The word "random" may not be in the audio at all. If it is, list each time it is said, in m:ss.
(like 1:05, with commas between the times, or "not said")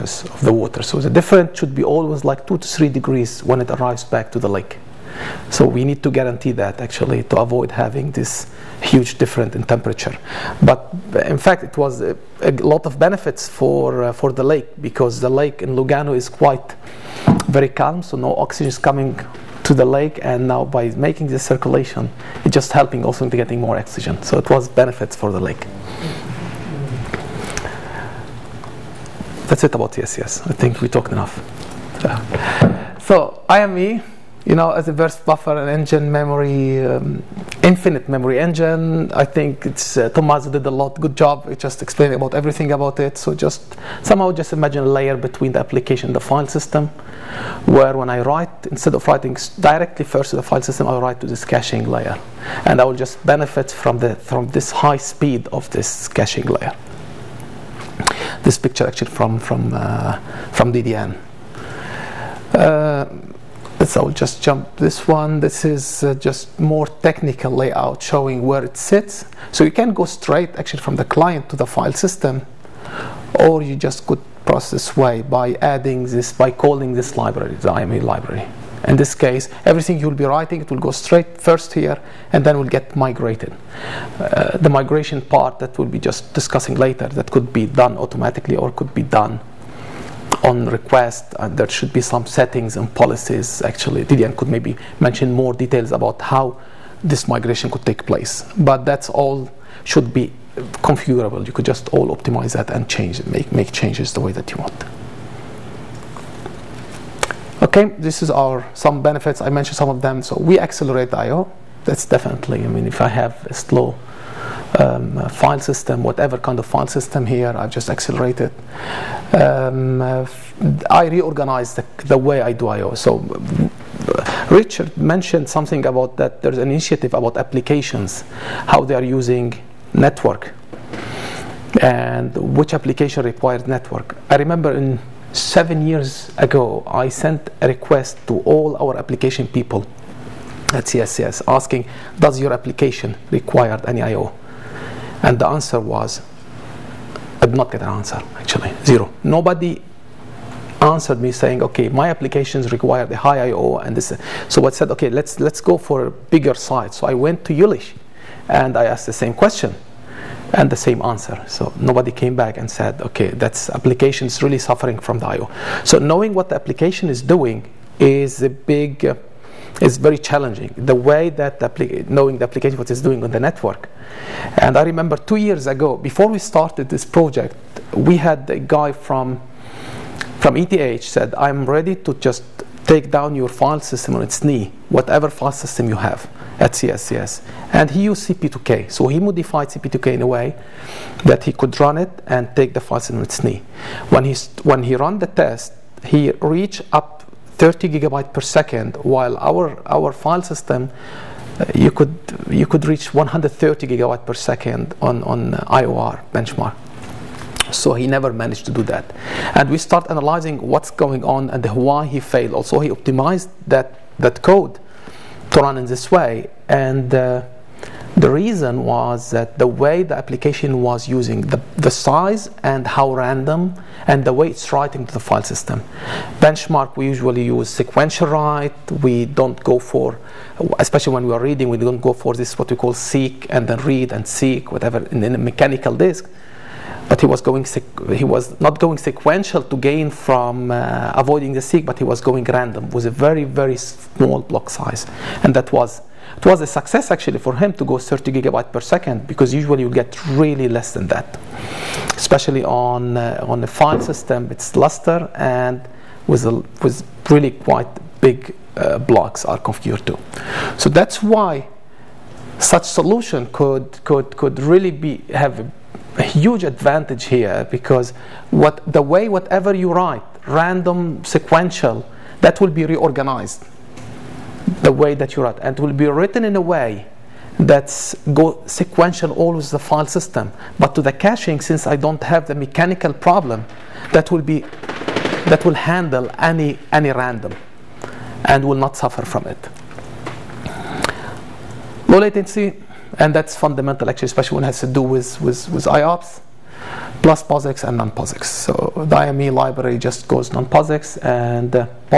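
3:43, 4:02, 4:30, 4:47.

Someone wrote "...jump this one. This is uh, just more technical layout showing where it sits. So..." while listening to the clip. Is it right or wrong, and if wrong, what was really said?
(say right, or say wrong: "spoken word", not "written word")
right.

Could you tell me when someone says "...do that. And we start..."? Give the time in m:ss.
3:28.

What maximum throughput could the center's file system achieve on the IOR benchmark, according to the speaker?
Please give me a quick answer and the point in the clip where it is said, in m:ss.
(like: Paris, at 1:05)
130 gigabytes per second, at 3:23.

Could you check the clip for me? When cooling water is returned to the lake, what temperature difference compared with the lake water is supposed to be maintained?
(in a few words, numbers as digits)
2 to 3 degrees.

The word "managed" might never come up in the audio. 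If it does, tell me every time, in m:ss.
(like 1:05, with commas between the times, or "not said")
3:28.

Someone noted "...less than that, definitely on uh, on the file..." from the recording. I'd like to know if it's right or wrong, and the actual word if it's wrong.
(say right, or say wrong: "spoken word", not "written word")
wrong: "especially", not "definitely".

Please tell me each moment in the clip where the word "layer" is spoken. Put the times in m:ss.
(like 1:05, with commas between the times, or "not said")
0:44, 0:51, 0:56.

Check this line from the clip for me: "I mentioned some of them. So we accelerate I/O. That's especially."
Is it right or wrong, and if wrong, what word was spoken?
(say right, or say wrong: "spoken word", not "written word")
wrong: "definitely", not "especially".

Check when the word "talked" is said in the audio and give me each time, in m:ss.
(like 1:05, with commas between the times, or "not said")
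0:30.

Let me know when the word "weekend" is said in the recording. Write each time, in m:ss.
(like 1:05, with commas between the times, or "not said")
not said.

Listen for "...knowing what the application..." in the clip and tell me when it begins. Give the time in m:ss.
2:46.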